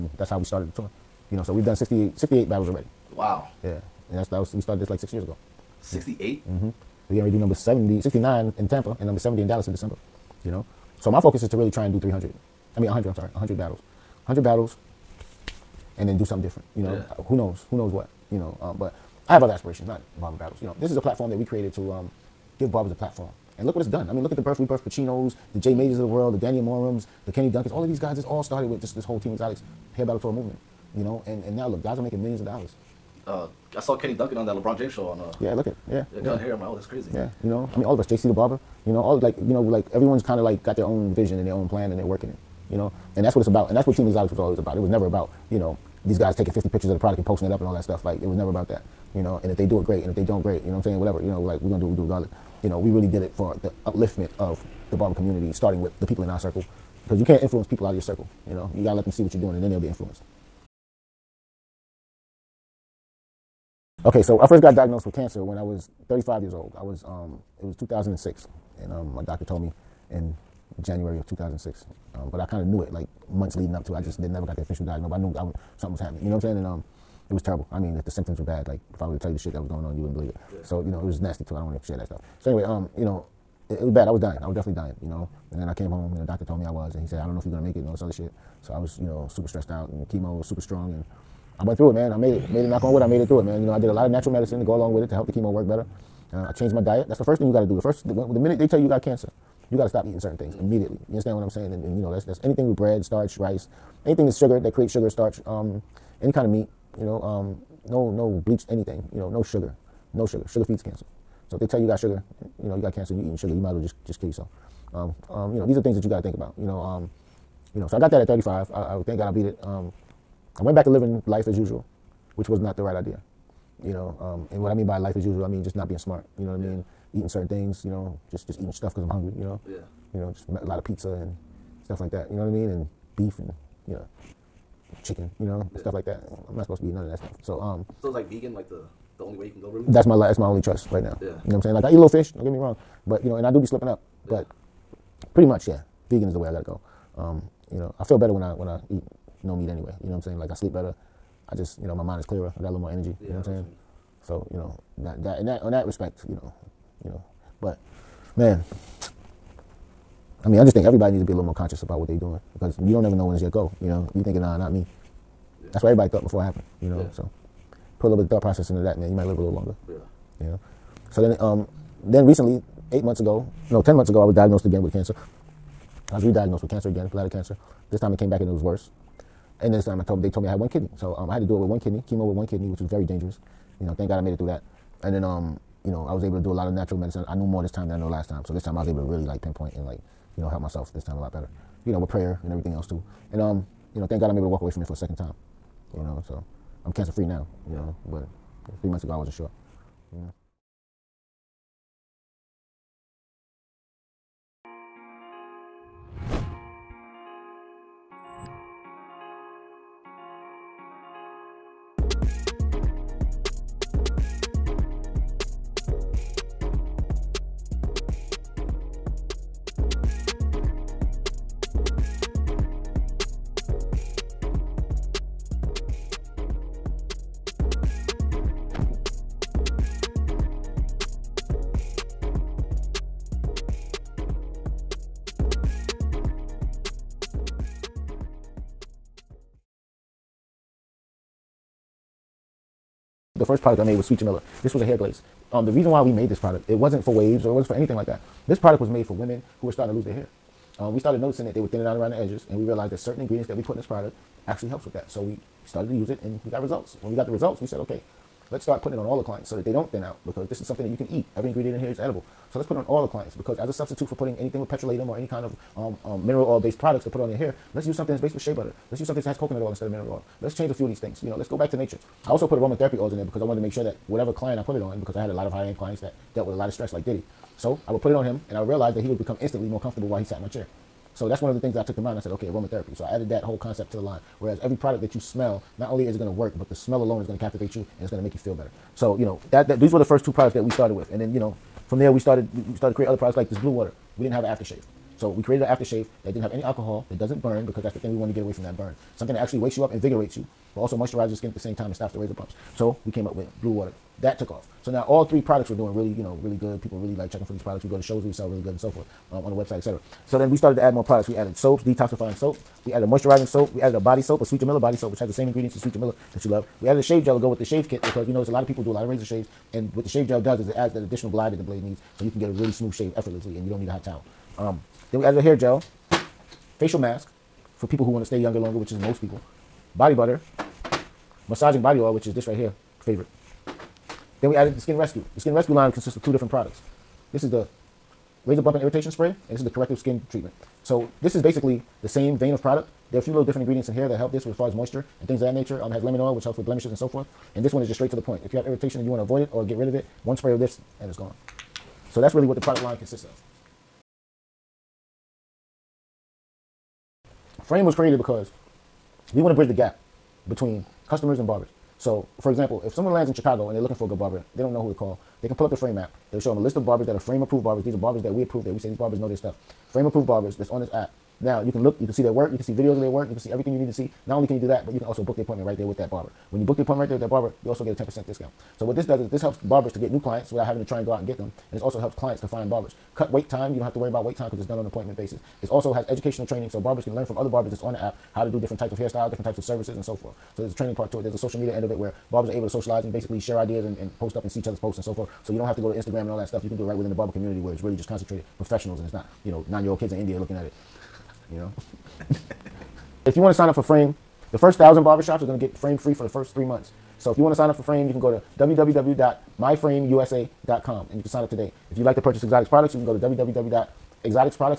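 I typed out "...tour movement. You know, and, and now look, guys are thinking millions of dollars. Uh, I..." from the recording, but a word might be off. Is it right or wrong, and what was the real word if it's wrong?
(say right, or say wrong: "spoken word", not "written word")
wrong: "making", not "thinking".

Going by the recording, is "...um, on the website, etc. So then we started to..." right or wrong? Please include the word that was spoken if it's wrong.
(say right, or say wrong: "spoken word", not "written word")
right.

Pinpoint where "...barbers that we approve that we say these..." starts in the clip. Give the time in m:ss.
6:07.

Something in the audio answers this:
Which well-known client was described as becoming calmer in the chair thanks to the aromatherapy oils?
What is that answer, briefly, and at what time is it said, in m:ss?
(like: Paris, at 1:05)
Diddy, at 4:37.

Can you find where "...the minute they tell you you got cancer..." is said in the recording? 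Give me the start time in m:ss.
1:38.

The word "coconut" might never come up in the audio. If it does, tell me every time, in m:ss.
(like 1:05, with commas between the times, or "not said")
4:29.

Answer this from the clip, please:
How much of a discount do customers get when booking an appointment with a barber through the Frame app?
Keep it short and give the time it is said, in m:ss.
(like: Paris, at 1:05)
10%, at 6:18.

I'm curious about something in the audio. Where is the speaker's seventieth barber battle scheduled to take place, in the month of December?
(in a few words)
Dallas.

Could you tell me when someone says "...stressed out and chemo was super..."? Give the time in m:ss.
1:29.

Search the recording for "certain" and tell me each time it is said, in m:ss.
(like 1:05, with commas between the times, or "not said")
1:40, 2:07, 4:12.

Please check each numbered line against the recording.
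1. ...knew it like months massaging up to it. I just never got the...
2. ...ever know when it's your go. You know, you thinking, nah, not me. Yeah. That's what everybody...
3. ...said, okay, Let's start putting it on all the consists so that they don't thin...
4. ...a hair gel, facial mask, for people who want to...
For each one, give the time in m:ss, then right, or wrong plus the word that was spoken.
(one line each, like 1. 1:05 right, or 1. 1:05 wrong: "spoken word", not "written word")
1. 1:12 wrong: "leading", not "massaging"
2. 2:43 right
3. 4:17 wrong: "clients", not "consists"
4. 5:25 right.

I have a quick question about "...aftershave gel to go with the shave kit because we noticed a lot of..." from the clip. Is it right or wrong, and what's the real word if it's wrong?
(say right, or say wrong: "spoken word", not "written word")
wrong: "shave", not "aftershave".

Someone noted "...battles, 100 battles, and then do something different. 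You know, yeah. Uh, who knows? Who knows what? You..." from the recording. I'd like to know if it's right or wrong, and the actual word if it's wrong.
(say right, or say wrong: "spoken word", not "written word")
right.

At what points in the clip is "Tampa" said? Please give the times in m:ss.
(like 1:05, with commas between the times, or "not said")
0:08.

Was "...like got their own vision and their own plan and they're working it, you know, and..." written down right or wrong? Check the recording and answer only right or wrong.
right.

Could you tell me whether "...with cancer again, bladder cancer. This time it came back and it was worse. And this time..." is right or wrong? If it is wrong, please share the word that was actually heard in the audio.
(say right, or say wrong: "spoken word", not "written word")
right.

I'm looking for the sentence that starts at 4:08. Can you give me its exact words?
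This product was made for women who were starting to lose their hair.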